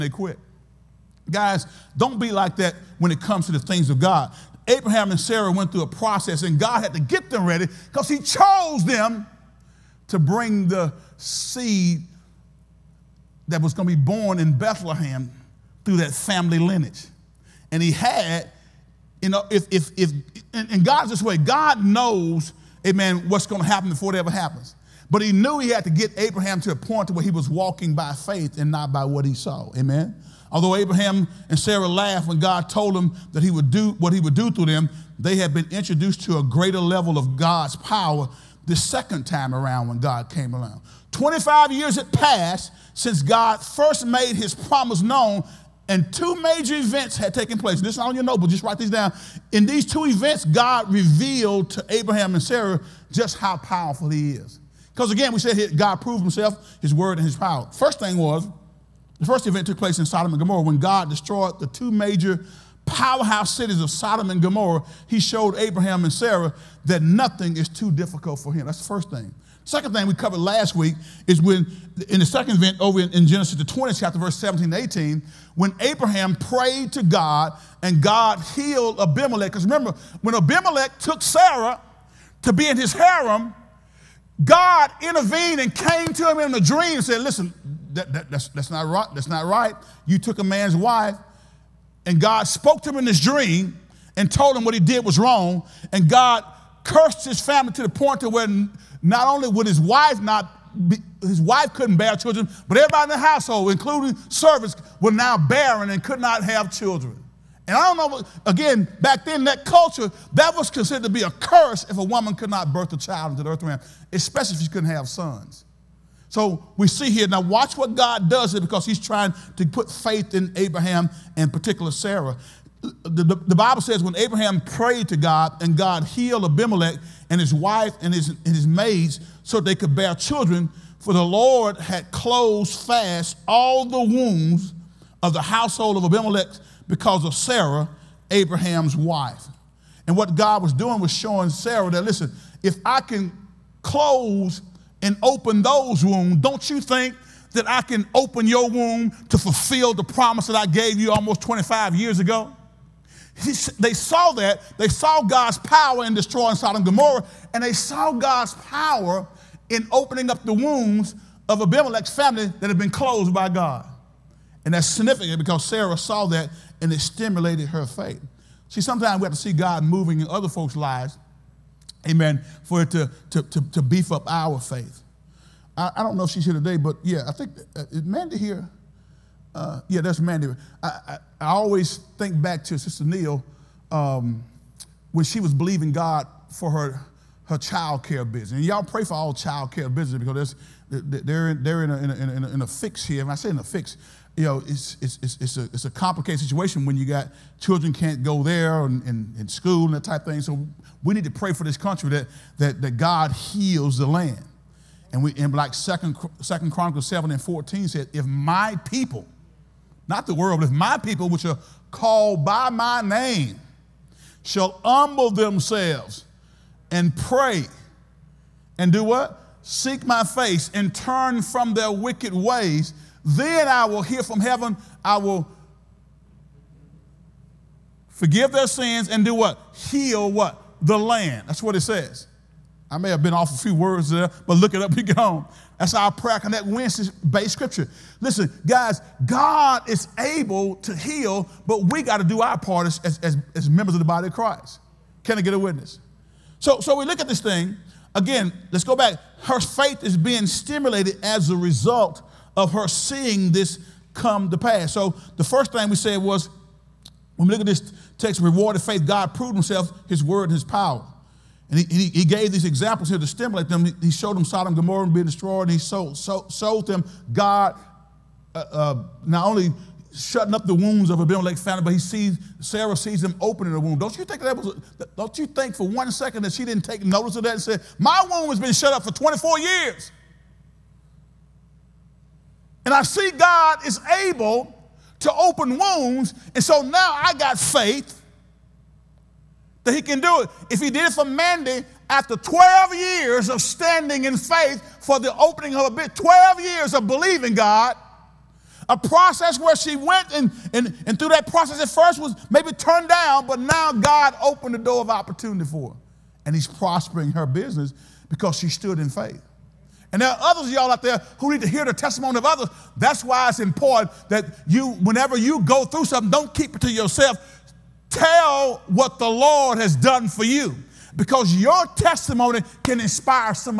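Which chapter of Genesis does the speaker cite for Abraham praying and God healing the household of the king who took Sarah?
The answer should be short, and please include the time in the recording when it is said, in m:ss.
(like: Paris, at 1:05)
20th chapter, at 1:13.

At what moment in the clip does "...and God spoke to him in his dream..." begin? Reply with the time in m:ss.
1:32.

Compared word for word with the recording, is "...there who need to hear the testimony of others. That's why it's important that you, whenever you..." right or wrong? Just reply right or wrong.
right.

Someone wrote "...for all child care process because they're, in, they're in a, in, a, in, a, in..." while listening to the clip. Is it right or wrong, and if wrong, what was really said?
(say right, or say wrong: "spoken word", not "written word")
wrong: "business", not "process".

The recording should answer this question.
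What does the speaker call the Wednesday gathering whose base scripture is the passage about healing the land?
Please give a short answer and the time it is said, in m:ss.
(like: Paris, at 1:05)
prayer connect, at 3:56.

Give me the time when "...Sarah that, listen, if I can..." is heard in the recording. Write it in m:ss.
2:21.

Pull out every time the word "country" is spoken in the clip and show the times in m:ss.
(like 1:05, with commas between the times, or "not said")
3:21.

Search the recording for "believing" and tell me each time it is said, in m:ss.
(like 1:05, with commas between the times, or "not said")
3:05, 4:57.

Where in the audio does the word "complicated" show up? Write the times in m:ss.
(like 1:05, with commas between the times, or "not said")
3:15.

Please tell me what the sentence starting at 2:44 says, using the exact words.
And that's significant because Sarah saw that and it stimulated her faith.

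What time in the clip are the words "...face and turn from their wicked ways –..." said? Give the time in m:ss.
3:40.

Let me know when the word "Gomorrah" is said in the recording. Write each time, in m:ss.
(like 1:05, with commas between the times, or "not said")
1:00, 1:04, 2:36, 4:24.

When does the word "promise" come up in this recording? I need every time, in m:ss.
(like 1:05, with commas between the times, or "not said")
0:44, 2:30.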